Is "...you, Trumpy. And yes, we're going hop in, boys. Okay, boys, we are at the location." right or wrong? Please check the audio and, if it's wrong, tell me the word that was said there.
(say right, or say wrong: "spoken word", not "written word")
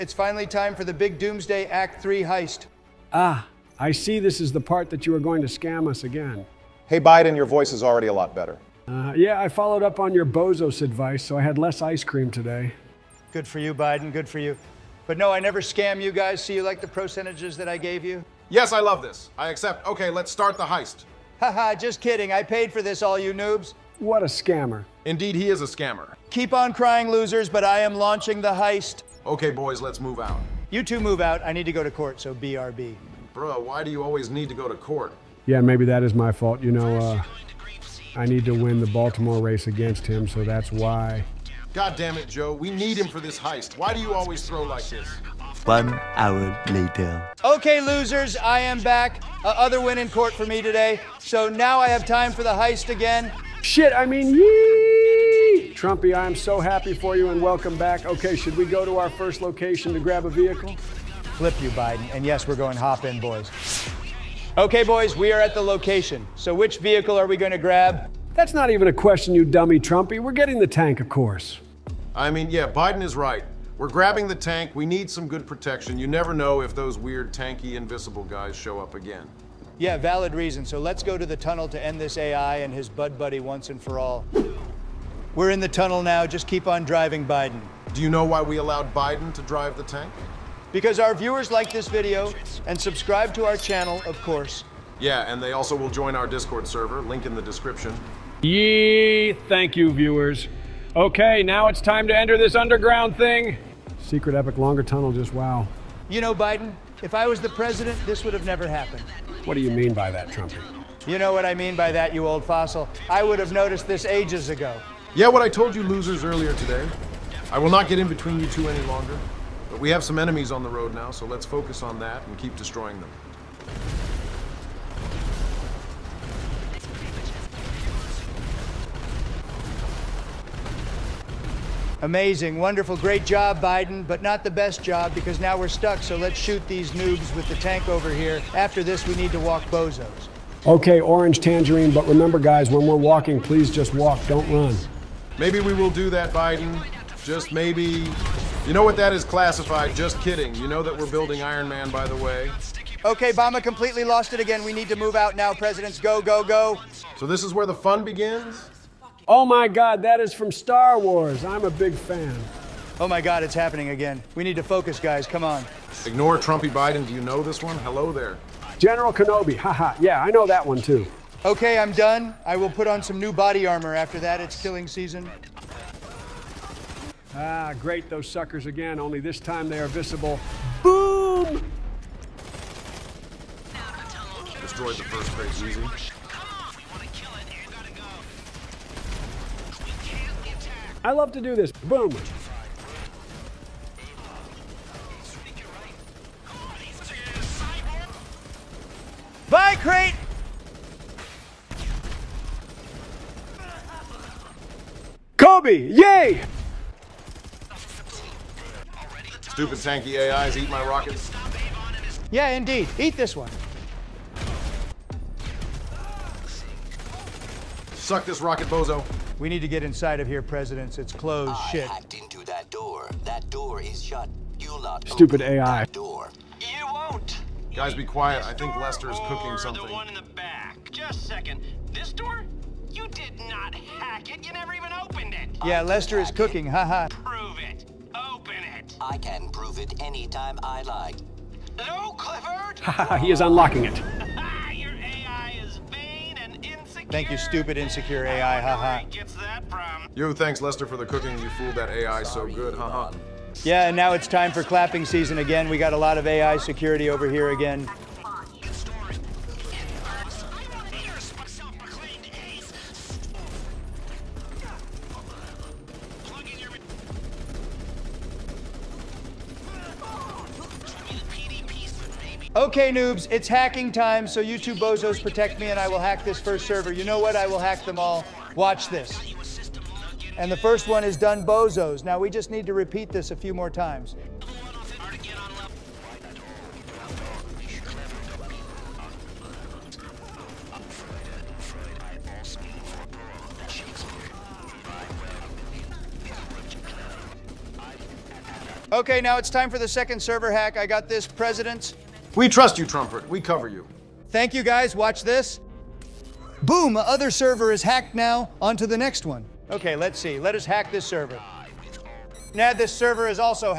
wrong: "Biden", not "Trumpy".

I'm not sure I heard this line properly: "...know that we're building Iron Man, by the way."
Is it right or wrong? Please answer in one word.
right.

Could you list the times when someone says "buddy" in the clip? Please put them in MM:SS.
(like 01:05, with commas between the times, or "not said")
01:23.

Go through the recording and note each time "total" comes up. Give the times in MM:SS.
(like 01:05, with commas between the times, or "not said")
not said.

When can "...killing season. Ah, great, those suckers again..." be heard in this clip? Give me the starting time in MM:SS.
02:54.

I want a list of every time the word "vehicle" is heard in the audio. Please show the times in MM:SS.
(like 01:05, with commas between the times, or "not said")
01:00, 01:06.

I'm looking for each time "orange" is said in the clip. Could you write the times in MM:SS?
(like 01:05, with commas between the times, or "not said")
02:21.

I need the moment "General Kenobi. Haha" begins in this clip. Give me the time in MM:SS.
02:48.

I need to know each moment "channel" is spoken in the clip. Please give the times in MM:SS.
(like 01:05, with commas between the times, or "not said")
01:33.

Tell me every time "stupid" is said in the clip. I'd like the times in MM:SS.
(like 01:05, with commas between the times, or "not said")
03:29, 03:45, 04:07.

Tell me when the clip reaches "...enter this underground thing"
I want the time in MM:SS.
01:42.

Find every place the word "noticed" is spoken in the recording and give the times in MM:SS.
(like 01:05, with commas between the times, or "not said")
01:53.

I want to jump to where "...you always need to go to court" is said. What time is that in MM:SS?
00:33.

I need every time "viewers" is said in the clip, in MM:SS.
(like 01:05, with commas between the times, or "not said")
01:31, 01:39.